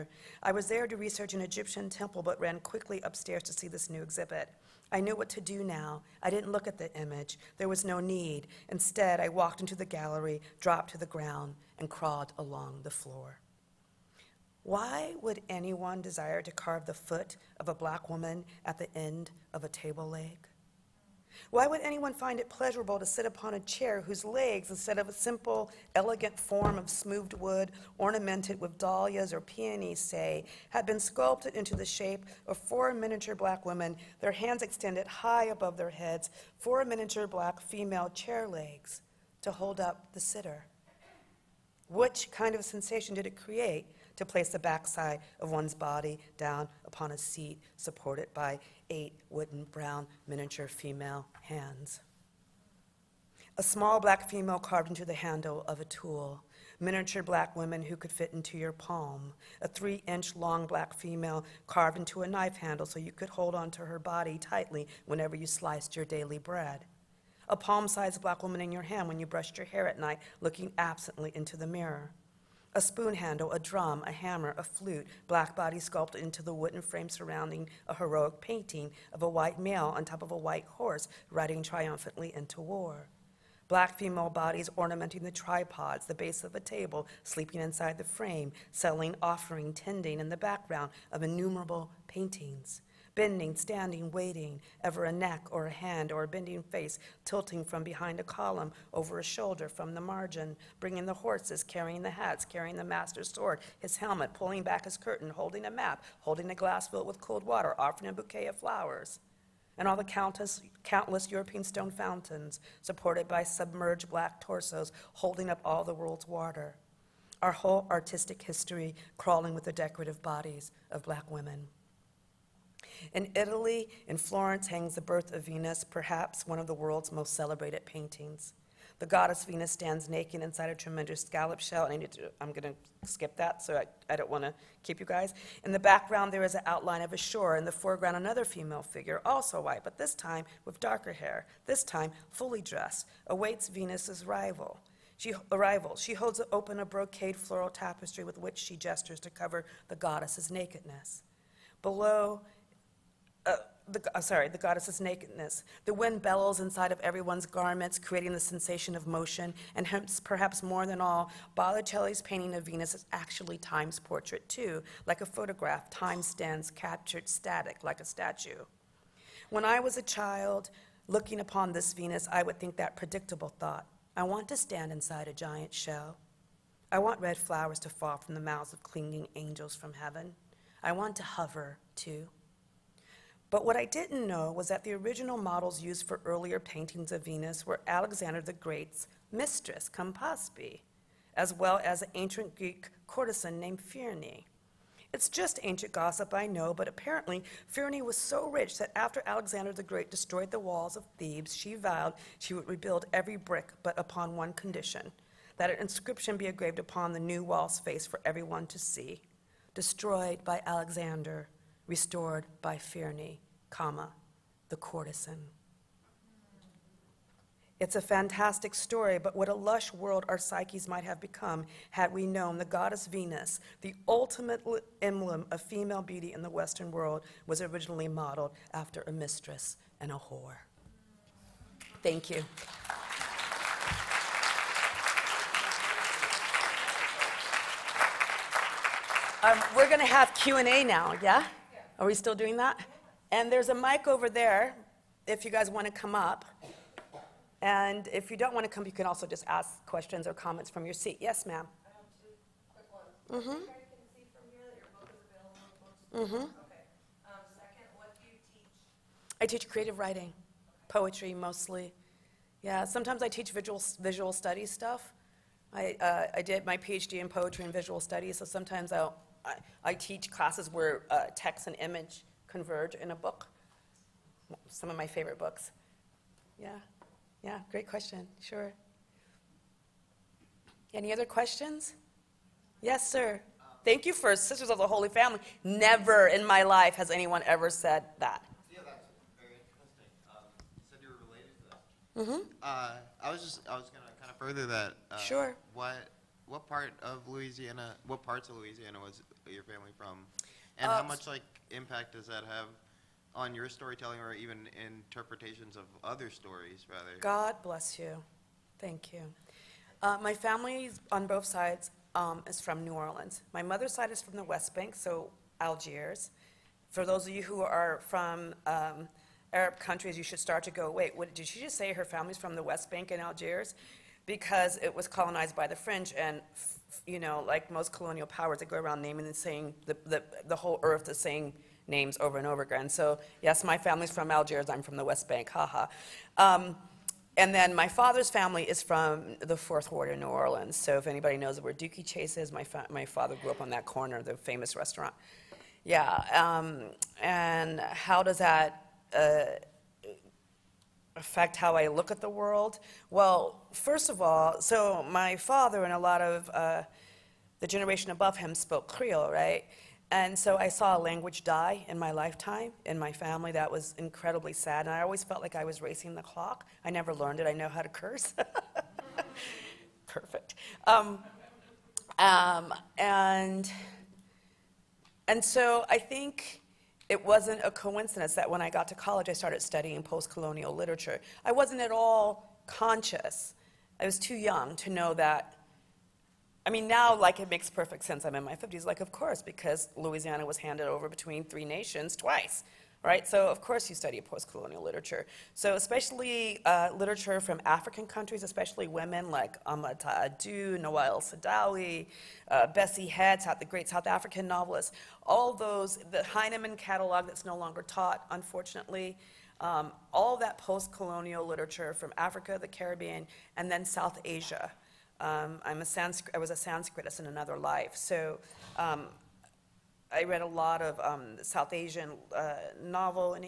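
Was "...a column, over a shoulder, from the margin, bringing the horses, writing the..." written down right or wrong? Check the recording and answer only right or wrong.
wrong.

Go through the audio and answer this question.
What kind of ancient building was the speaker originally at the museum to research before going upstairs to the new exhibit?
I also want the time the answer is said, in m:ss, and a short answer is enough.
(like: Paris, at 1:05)
Egyptian temple, at 0:01.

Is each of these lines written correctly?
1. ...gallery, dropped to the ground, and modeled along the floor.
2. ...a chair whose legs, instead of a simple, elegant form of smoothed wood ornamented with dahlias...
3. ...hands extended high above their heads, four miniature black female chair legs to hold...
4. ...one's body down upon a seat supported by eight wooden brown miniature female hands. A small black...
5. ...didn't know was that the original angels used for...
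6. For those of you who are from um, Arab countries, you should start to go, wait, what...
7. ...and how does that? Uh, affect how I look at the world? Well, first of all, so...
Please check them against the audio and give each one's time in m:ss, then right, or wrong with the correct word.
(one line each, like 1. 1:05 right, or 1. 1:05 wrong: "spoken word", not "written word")
1. 0:09 wrong: "crawled", not "modeled"
2. 0:23 right
3. 0:34 right
4. 0:45 right
5. 3:03 wrong: "models", not "angels"
6. 5:16 right
7. 5:47 right.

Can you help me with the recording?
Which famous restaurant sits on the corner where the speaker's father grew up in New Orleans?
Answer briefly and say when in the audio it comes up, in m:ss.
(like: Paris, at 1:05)
Dooky Chase, at 5:41.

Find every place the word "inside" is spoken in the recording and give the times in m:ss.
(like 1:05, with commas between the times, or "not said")
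1:27, 2:10, 2:36, 2:54.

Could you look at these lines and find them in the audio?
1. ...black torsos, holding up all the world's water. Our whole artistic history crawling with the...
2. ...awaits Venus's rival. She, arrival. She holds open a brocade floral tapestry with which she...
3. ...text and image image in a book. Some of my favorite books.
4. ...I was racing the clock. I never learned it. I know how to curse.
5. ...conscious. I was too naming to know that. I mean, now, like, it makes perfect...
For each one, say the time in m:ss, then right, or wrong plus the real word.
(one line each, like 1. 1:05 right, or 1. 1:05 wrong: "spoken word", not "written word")
1. 1:54 right
2. 2:23 right
3. 4:31 wrong: "converge", not "image"
4. 6:05 right
5. 6:22 wrong: "young", not "naming".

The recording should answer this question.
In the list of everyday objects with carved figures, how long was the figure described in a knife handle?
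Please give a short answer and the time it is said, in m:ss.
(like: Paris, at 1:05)
3 inch, at 0:59.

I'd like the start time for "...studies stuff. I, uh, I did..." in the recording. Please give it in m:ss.
4:24.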